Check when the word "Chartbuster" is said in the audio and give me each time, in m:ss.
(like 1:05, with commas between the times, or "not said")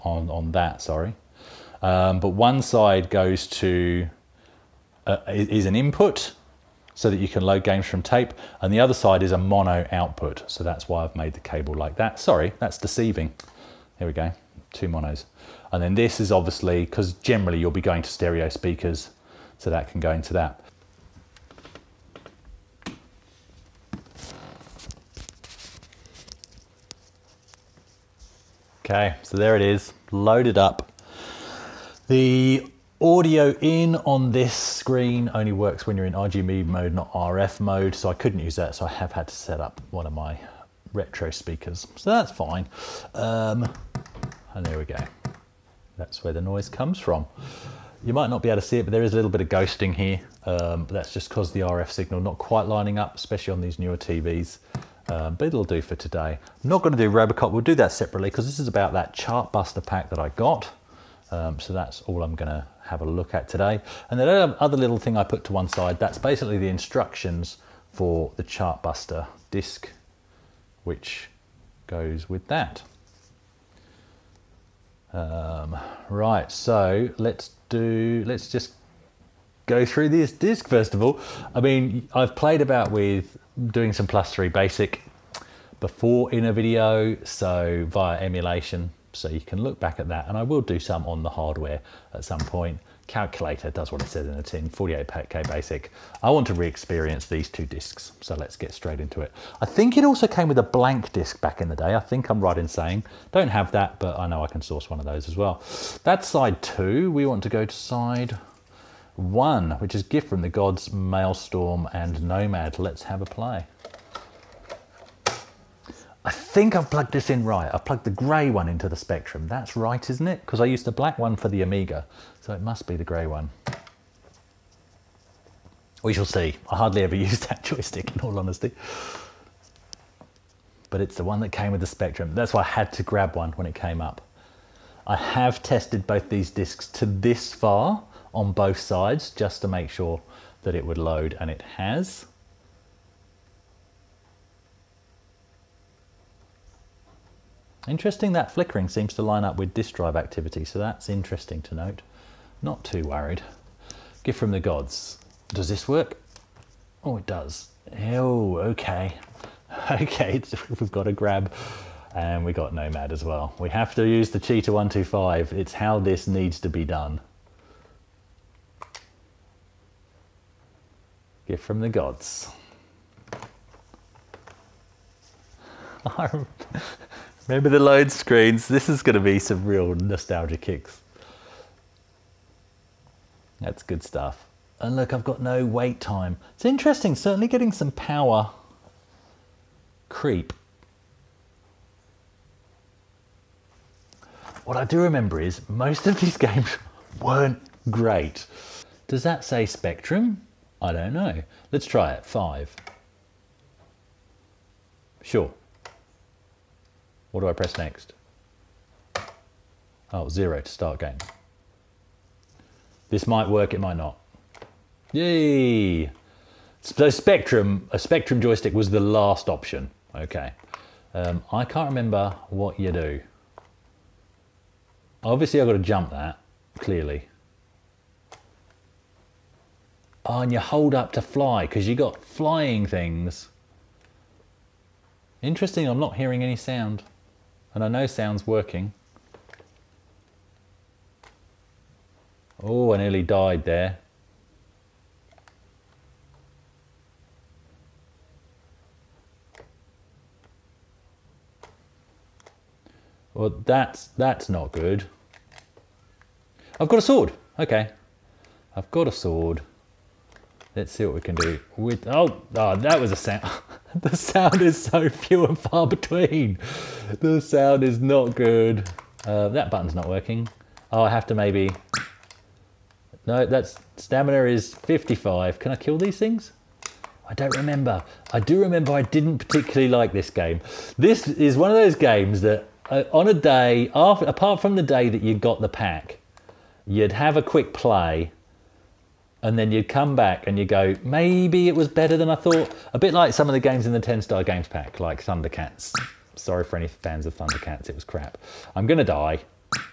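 0:59, 1:08.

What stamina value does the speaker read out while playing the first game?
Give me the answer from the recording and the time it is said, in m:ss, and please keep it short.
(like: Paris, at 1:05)
55, at 4:34.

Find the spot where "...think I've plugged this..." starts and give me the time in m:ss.
1:56.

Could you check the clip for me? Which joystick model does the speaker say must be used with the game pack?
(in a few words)
Cheetah 125.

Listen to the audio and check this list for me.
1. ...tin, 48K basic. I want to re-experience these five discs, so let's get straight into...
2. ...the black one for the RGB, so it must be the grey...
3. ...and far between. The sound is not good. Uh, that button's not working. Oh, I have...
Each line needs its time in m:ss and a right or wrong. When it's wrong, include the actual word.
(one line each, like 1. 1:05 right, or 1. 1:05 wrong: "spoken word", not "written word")
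1. 1:34 wrong: "two", not "five"
2. 2:00 wrong: "Amiga", not "RGB"
3. 4:25 right.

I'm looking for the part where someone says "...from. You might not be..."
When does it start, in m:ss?
0:46.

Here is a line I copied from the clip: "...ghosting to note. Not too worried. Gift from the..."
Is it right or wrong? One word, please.
wrong.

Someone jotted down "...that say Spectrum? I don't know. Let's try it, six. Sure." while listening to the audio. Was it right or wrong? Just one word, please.
wrong.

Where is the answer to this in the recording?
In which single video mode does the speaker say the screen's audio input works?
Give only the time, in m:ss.
0:36.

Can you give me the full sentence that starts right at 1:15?
Um, right, so let's do, let's just go through this disc, first of all.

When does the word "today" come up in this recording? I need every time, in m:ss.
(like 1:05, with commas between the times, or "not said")
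0:55, 1:03.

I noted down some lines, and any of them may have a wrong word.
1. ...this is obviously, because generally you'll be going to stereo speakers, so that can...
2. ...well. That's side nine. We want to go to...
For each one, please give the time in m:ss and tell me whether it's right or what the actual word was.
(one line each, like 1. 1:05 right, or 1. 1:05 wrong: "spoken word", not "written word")
1. 0:15 right
2. 1:45 wrong: "two", not "nine".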